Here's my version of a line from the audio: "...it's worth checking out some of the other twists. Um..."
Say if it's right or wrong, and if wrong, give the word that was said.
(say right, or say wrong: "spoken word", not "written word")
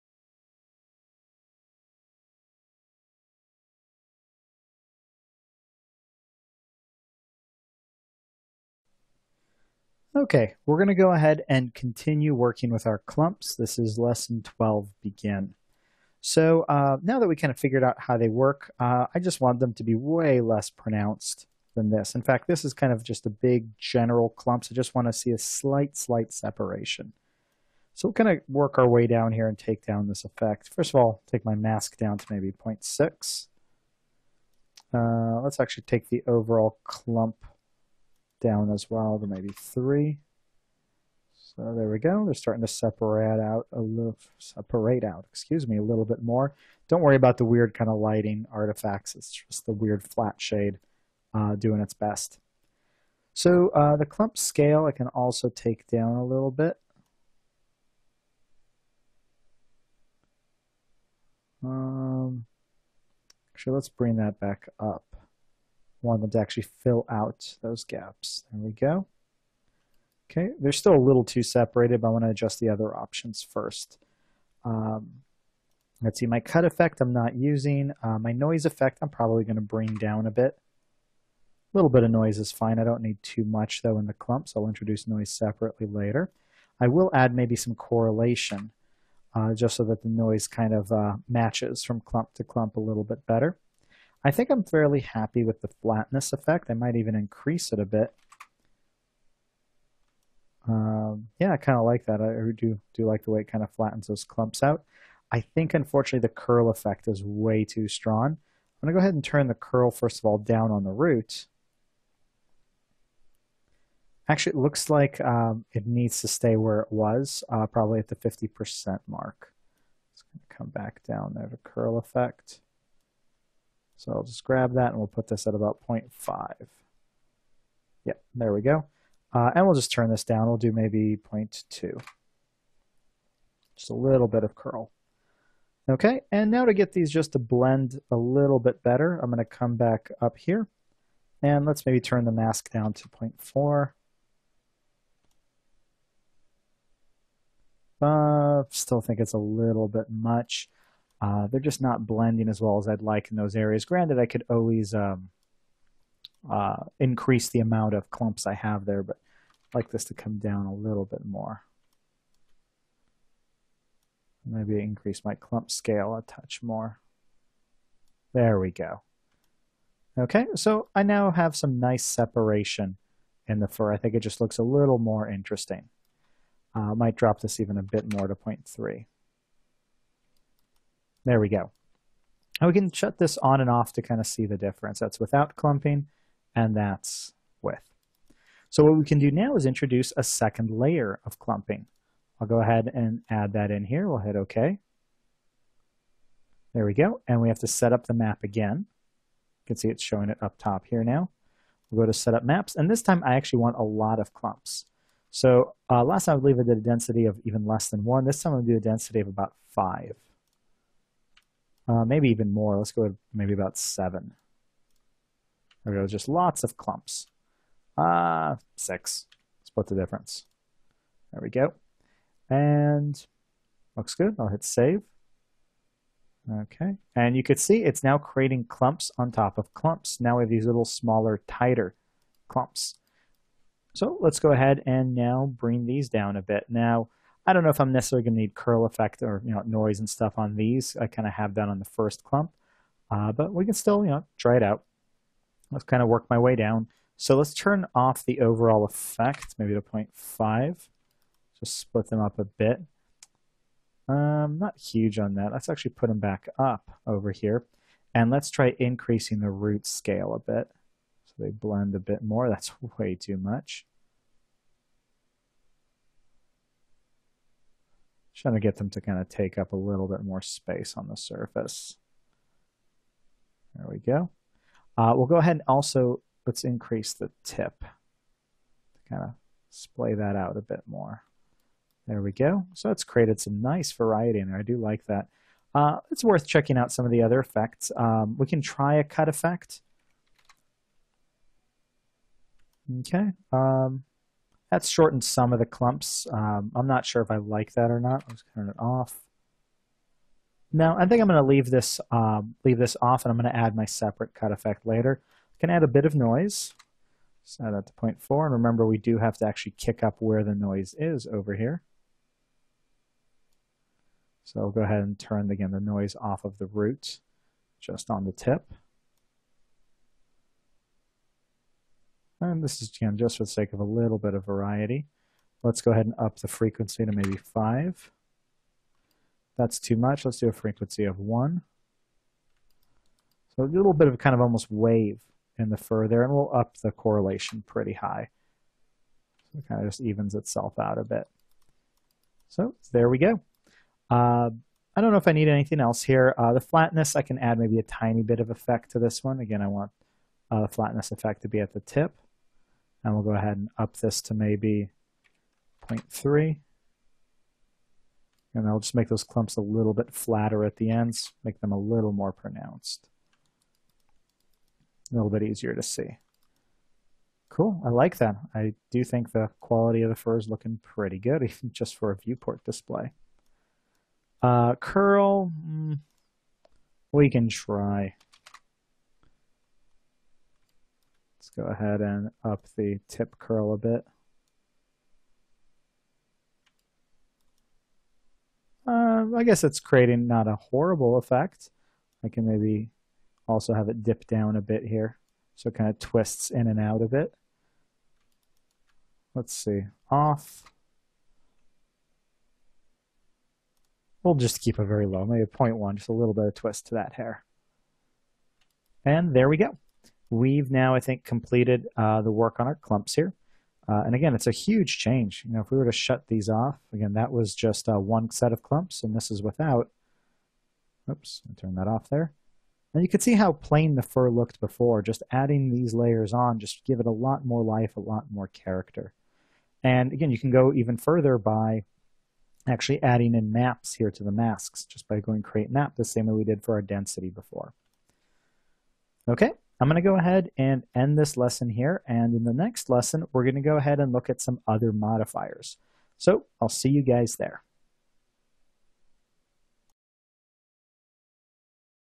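wrong: "effects", not "twists".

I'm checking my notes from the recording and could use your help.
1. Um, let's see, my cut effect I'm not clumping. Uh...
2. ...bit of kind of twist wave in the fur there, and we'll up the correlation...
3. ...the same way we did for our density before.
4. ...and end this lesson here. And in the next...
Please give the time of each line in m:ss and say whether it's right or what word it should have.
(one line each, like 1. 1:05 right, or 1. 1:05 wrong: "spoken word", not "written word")
1. 1:14 wrong: "using", not "clumping"
2. 5:33 wrong: "almost", not "twist"
3. 7:15 right
4. 7:20 right.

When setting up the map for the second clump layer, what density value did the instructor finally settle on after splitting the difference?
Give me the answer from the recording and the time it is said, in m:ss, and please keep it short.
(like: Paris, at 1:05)
6, at 3:38.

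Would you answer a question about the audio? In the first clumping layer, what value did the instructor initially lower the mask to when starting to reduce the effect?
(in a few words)
0.6.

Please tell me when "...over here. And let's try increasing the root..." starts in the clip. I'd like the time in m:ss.
4:17.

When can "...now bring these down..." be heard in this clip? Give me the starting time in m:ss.
3:55.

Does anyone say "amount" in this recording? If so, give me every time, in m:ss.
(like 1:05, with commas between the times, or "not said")
2:37.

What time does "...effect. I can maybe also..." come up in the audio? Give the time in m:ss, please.
6:31.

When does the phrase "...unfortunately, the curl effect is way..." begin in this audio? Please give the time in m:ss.
1:45.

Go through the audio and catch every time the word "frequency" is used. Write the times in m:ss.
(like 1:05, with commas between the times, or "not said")
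5:26, 5:30.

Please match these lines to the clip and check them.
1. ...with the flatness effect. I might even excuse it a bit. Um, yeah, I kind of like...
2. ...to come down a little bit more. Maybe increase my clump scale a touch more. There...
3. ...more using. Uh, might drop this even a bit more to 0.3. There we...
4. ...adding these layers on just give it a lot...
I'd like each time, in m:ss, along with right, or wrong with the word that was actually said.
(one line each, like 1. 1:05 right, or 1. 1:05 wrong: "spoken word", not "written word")
1. 1:35 wrong: "increase", not "excuse"
2. 2:40 right
3. 2:54 wrong: "interesting", not "using"
4. 7:05 right.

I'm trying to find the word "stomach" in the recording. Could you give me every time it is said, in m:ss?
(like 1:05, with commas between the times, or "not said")
not said.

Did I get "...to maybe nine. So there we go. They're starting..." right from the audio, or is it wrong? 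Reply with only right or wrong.
wrong.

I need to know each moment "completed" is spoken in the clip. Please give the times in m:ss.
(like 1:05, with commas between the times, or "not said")
6:51.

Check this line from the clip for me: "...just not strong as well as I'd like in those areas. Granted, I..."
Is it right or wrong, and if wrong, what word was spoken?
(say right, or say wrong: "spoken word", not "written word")
wrong: "blending", not "strong".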